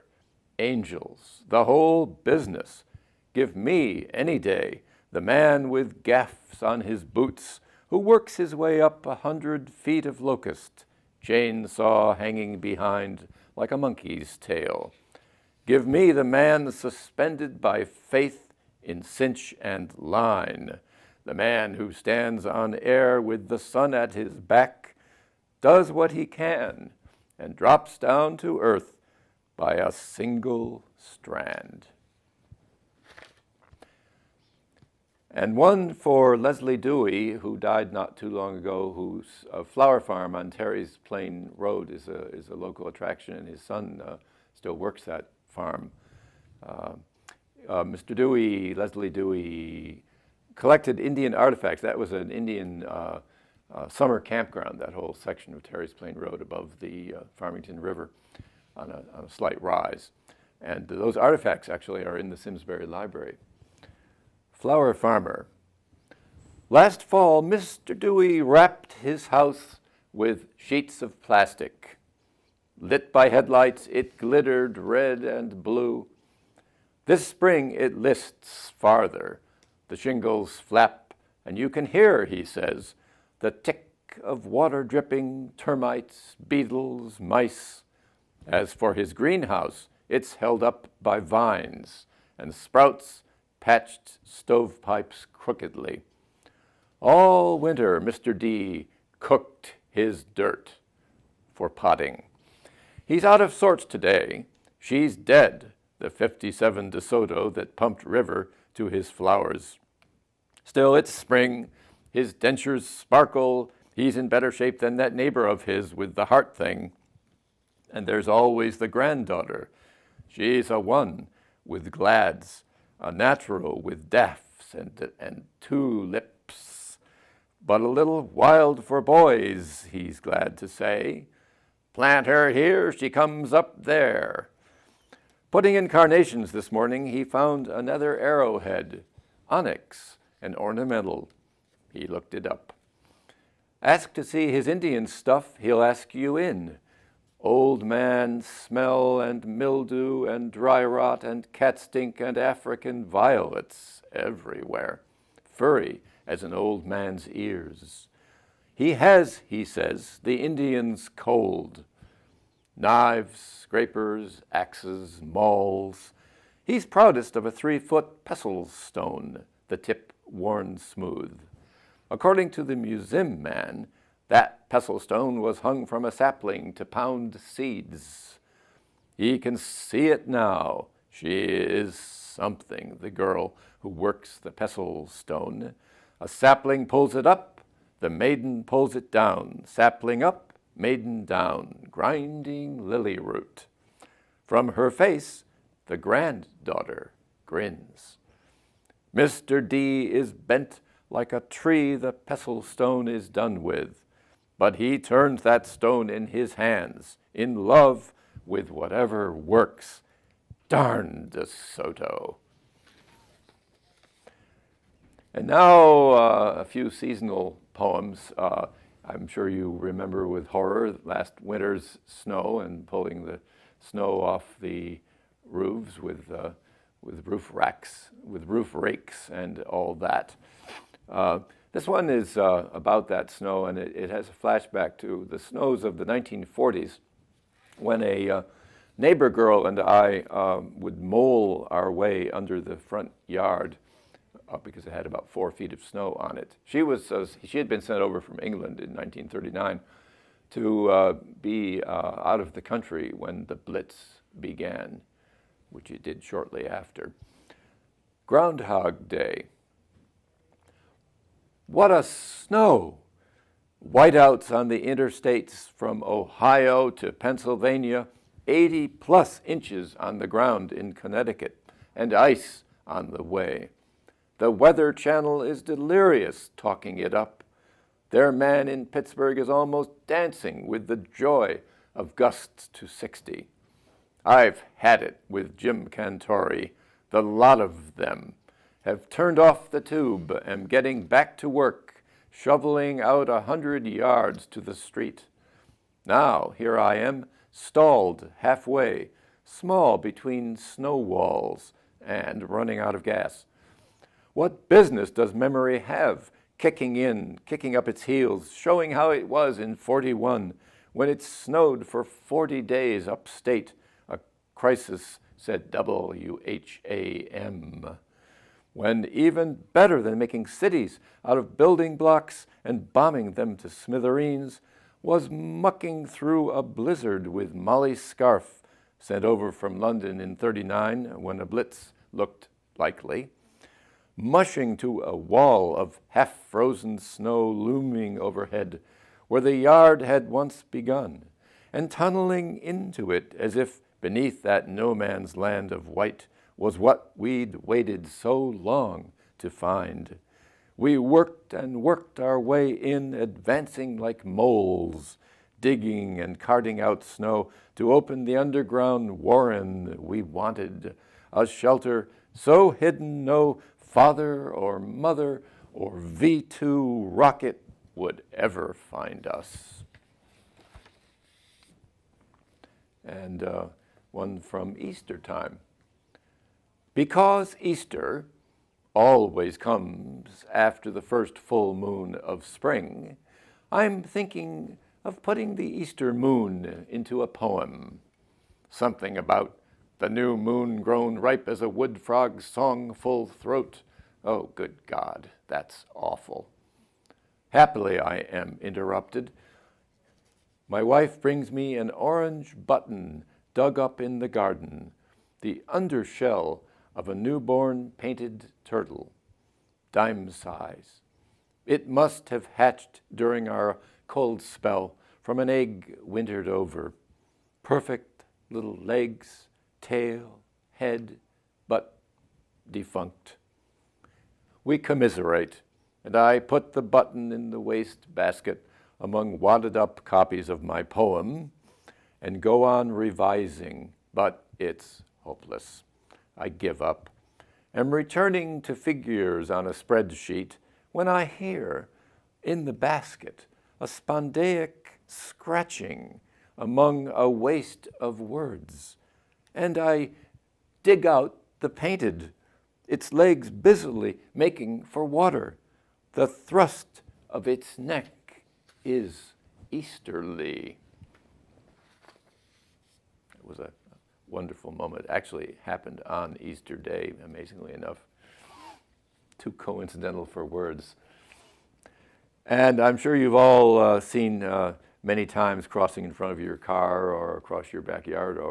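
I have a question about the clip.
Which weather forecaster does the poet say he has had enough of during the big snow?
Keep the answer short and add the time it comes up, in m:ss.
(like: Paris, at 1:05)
Jim Cantore, at 4:45.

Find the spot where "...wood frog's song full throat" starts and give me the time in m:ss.
6:31.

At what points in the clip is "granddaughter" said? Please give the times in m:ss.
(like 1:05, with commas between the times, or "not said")
1:58, 3:15.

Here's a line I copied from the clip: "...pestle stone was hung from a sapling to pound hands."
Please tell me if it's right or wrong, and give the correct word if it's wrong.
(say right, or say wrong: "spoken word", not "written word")
wrong: "seeds", not "hands".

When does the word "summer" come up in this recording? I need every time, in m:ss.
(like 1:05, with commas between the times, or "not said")
0:53.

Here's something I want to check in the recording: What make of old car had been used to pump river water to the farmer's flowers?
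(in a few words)
DeSoto.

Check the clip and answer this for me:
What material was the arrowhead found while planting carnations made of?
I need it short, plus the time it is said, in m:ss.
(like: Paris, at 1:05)
Onyx, at 2:19.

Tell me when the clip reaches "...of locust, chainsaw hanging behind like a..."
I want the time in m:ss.
0:10.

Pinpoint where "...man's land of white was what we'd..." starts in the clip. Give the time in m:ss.
5:44.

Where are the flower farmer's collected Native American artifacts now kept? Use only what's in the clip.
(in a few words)
Simsbury Library.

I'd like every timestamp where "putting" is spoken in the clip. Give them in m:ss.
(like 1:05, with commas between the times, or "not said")
2:15, 6:25.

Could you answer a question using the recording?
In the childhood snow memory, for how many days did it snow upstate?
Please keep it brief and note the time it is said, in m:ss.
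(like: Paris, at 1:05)
40, at 5:12.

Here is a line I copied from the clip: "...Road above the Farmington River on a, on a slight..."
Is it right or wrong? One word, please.
right.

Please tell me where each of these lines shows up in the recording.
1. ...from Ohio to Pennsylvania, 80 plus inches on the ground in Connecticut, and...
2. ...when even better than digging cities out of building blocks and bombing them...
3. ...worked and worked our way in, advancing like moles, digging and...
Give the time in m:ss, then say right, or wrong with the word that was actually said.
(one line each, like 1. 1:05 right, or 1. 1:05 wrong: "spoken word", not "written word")
1. 4:25 right
2. 5:18 wrong: "making", not "digging"
3. 5:50 right.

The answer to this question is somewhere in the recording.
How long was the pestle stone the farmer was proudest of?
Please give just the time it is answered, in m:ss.
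2:47.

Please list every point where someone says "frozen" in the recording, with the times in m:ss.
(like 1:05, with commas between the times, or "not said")
5:36.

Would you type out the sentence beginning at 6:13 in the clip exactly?
And uh, one from Easter time.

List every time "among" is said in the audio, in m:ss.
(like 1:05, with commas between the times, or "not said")
7:08, 7:26.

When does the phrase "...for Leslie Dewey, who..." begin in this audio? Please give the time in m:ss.
0:35.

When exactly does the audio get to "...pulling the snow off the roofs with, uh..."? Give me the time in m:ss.
3:42.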